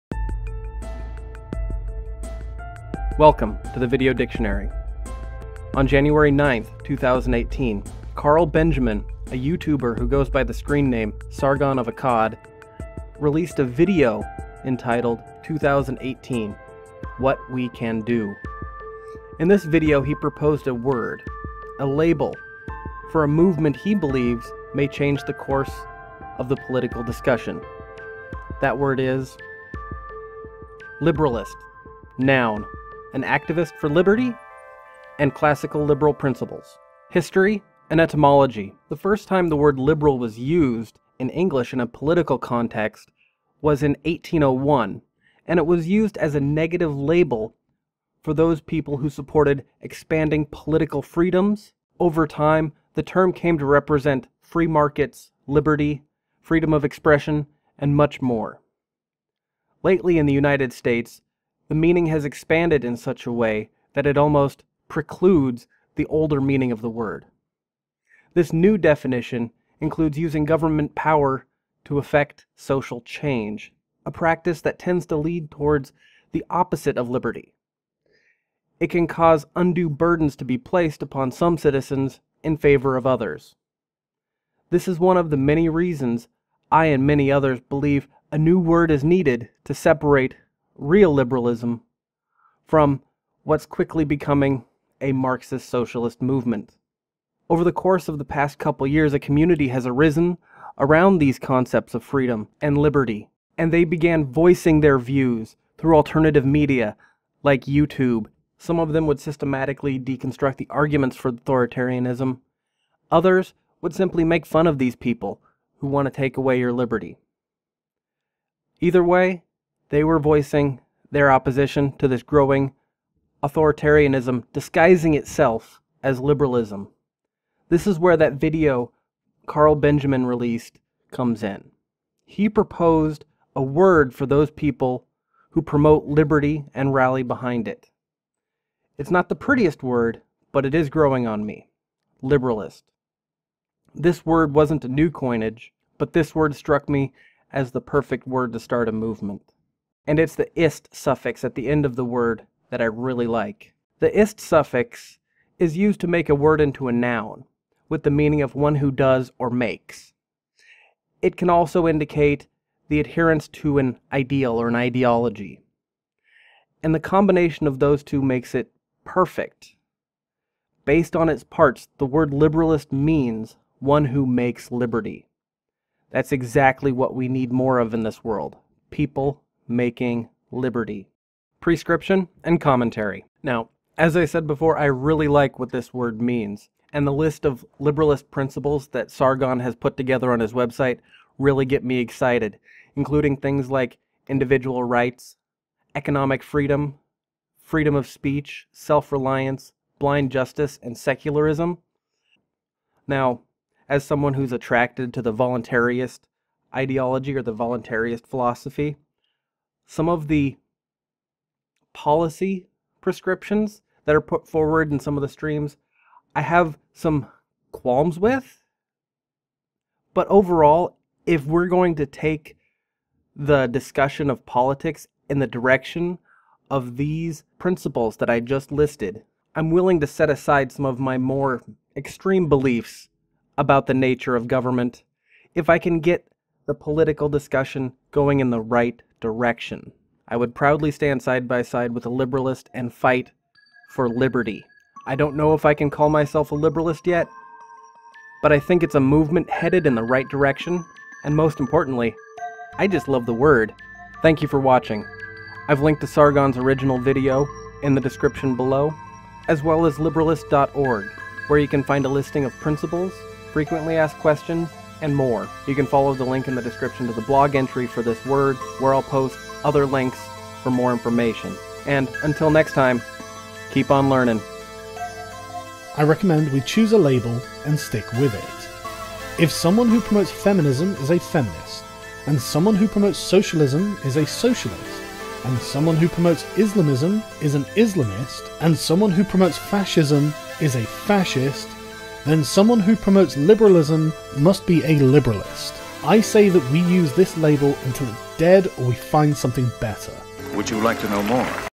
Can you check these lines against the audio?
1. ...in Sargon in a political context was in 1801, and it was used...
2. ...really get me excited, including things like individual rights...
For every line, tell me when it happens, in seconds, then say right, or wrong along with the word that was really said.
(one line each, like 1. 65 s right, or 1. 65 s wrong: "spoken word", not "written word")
1. 41 s wrong: "English", not "Sargon"
2. 191 s right.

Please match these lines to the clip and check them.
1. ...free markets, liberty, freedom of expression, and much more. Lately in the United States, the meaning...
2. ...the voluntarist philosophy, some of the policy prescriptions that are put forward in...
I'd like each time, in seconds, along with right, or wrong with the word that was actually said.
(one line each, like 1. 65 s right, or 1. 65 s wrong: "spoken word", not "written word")
1. 54 s right
2. 207 s right.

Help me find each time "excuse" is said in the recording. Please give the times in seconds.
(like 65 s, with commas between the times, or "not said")
not said.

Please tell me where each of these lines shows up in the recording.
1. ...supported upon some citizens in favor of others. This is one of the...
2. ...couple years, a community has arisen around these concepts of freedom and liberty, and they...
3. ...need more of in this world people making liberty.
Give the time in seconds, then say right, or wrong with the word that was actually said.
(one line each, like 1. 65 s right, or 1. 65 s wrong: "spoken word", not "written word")
1. 80 s wrong: "placed", not "supported"
2. 98 s right
3. 177 s right.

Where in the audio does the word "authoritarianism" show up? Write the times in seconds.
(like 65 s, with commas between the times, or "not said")
111 s, 123 s.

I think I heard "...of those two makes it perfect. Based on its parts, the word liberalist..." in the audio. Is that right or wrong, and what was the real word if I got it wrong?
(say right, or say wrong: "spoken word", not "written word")
right.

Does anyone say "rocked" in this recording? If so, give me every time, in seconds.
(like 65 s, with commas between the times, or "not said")
not said.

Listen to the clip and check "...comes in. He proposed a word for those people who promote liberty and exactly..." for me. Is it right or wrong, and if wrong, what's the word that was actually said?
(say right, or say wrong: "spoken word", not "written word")
wrong: "rally", not "exactly".